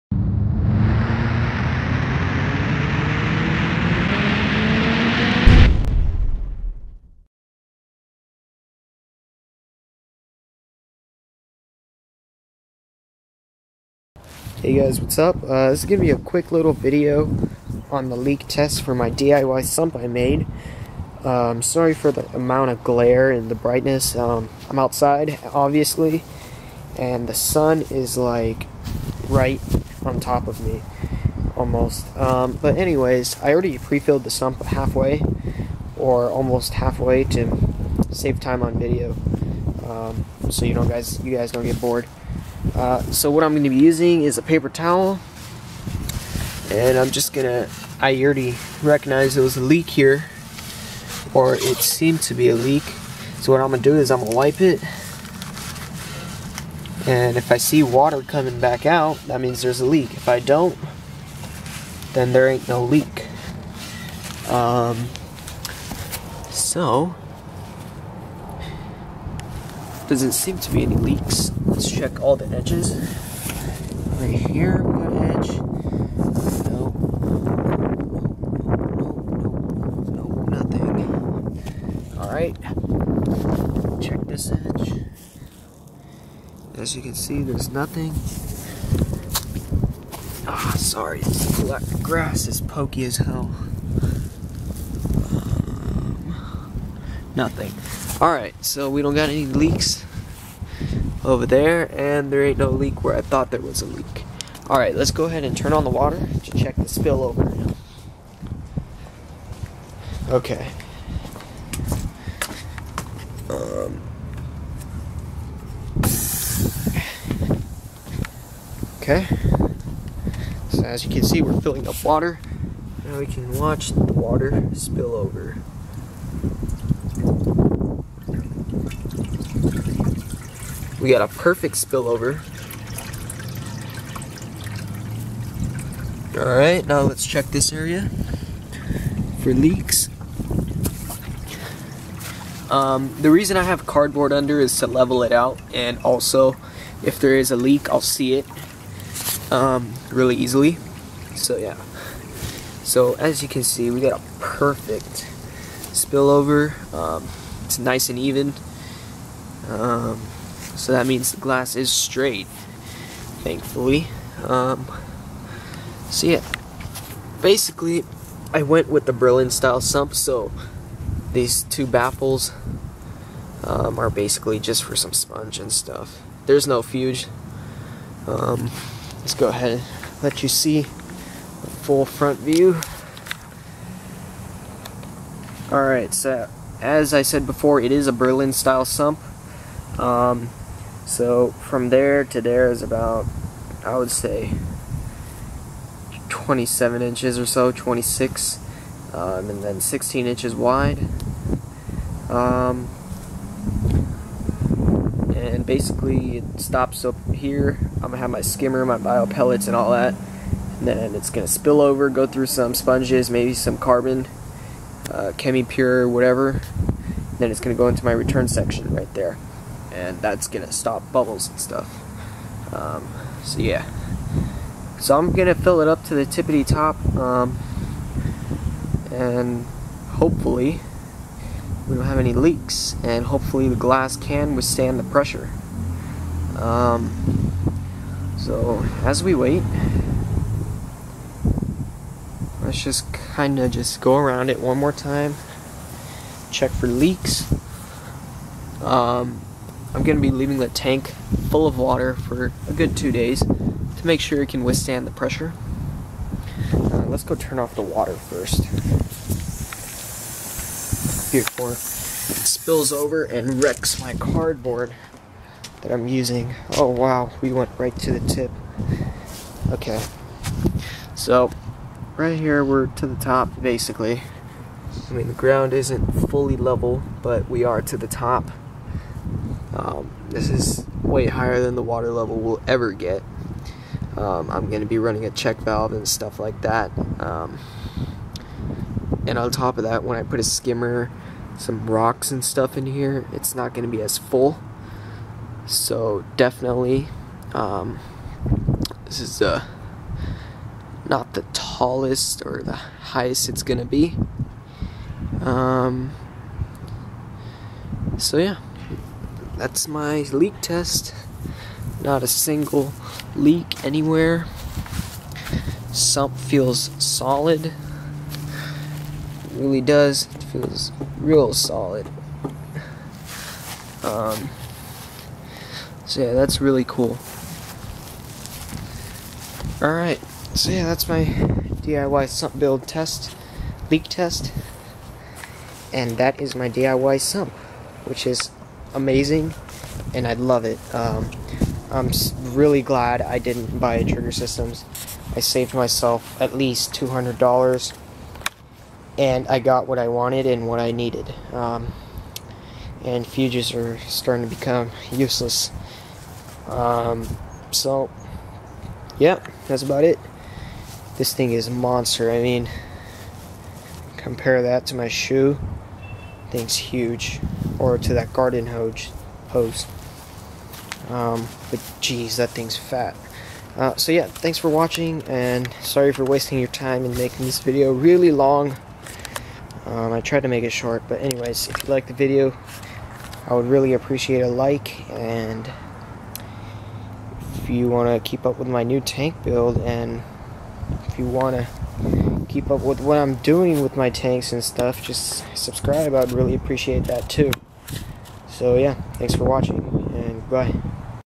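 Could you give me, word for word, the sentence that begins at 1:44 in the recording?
Alright, let's go ahead and turn on the water to check the spill over.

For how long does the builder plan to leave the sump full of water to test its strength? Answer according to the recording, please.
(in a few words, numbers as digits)
Two days.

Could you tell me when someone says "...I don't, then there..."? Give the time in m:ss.
1:00.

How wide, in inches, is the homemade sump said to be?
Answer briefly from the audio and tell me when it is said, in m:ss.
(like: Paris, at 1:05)
16 inches, at 3:19.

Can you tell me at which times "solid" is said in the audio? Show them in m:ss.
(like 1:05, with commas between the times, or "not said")
5:16, 5:21.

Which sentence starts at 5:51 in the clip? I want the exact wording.
Um, and fuges are starting to become useless.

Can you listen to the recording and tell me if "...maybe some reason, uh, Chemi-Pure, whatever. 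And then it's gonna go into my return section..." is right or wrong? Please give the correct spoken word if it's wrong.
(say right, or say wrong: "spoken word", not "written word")
wrong: "carbon", not "reason".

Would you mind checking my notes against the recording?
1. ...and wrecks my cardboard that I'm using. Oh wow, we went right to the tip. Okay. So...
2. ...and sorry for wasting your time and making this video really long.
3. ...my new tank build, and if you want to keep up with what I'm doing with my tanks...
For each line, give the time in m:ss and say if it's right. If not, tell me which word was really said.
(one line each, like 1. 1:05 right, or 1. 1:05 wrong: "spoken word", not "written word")
1. 4:23 right
2. 6:15 right
3. 6:28 right.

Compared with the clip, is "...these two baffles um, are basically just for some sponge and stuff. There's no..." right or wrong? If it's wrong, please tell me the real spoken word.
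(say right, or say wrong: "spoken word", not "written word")
right.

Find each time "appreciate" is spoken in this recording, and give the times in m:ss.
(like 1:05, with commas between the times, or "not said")
6:23, 6:36.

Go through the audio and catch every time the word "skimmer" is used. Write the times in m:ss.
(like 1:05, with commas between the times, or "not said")
3:28, 4:50.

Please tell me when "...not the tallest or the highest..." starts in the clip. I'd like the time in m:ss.
5:01.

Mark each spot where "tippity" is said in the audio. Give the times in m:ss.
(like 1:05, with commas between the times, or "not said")
3:46.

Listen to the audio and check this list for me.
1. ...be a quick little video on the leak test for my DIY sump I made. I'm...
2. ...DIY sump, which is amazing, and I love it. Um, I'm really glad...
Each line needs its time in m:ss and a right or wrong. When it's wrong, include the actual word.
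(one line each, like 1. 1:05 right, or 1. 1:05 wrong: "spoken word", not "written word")
1. 0:16 right
2. 5:36 right.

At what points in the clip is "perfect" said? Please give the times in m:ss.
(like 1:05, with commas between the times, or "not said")
2:11, 2:34.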